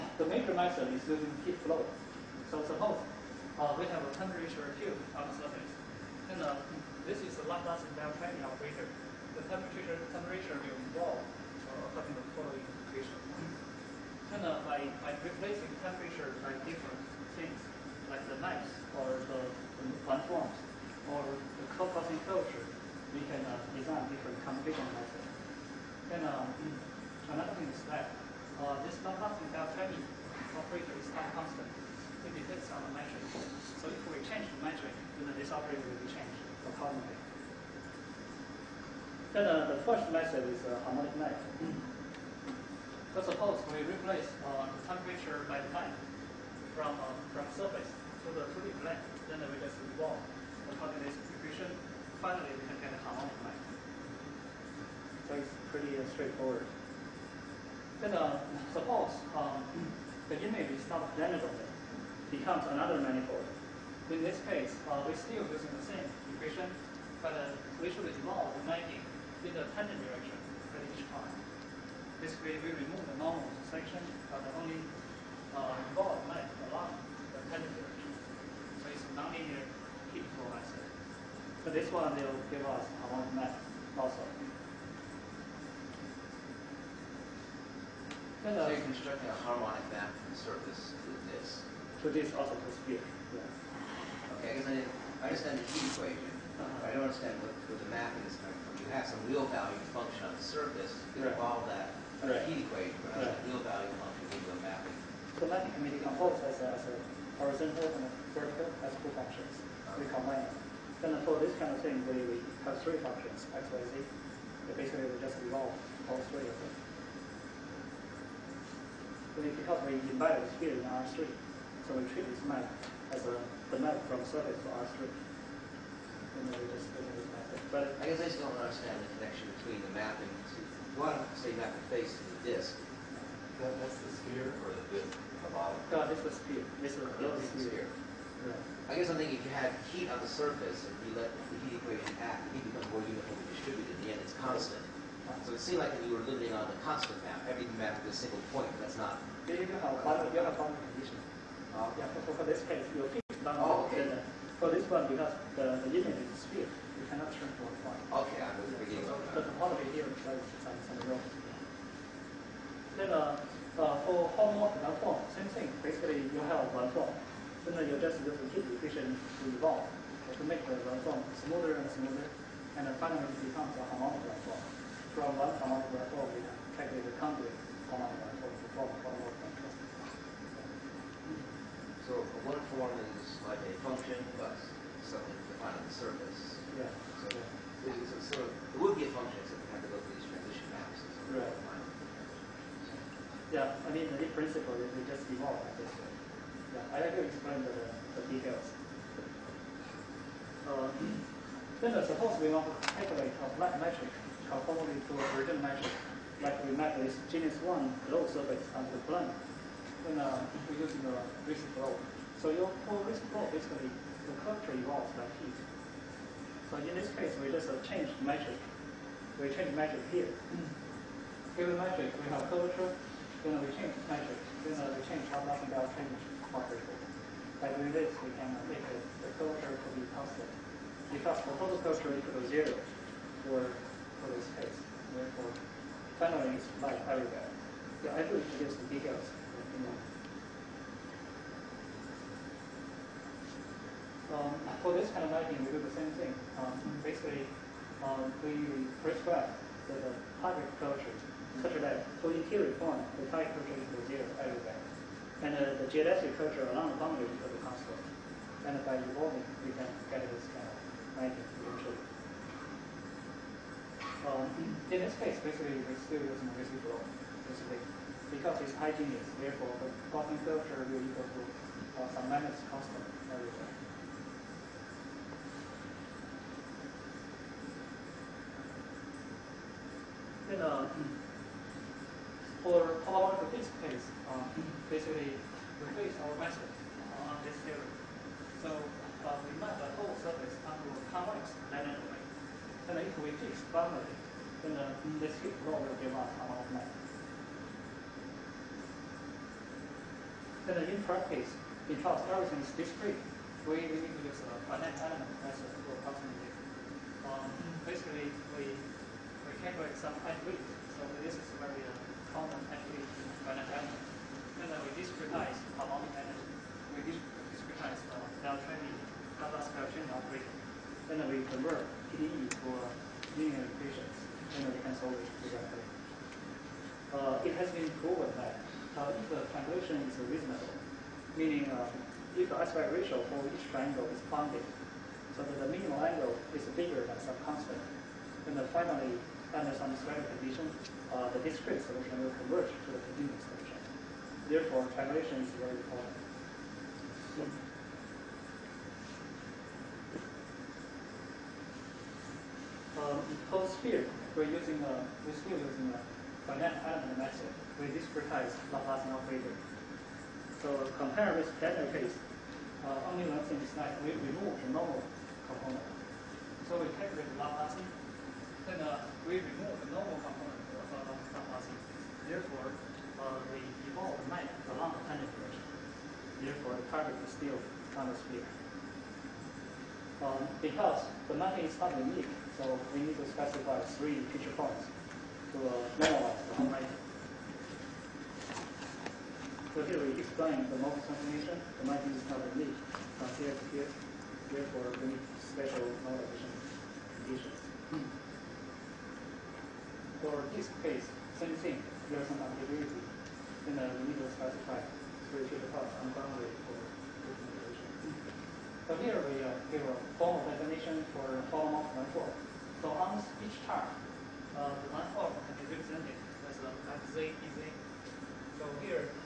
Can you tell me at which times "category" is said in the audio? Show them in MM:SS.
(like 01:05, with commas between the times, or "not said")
05:09.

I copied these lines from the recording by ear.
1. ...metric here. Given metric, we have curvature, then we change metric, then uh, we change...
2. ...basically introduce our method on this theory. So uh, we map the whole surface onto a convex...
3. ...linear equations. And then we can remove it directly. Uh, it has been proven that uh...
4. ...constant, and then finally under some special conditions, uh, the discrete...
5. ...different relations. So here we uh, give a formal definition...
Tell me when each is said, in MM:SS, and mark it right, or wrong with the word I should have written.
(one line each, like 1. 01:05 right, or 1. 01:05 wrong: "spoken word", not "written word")
1. 03:39 right
2. 04:44 wrong: "replace", not "introduce"
3. 05:23 wrong: "solve", not "remove"
4. 05:37 right
5. 06:47 right.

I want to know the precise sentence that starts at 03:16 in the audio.
Yeah, I have to explain the, the details.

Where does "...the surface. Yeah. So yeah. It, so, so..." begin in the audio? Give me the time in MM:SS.
03:05.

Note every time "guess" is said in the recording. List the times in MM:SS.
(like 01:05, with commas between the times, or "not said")
01:34, 02:08, 02:18.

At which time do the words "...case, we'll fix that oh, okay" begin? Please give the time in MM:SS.
02:32.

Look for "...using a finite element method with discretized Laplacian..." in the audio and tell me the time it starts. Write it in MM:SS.
05:55.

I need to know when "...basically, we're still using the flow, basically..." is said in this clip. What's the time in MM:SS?
04:25.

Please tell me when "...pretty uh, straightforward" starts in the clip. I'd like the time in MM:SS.
00:55.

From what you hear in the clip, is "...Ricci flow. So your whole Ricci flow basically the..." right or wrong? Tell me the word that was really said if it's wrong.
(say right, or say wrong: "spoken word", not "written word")
right.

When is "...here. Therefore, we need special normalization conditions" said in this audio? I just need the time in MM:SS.
06:33.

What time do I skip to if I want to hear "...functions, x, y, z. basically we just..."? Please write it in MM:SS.
01:53.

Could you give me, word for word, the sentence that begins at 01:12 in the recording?
Basically, we remove the normal section, but only uh, involve map along the tangent direction.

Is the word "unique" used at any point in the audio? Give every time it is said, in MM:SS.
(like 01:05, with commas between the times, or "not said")
06:21, 06:32.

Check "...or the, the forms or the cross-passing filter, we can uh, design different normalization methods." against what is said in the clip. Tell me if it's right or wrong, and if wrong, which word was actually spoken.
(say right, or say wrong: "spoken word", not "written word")
wrong: "computation", not "normalization".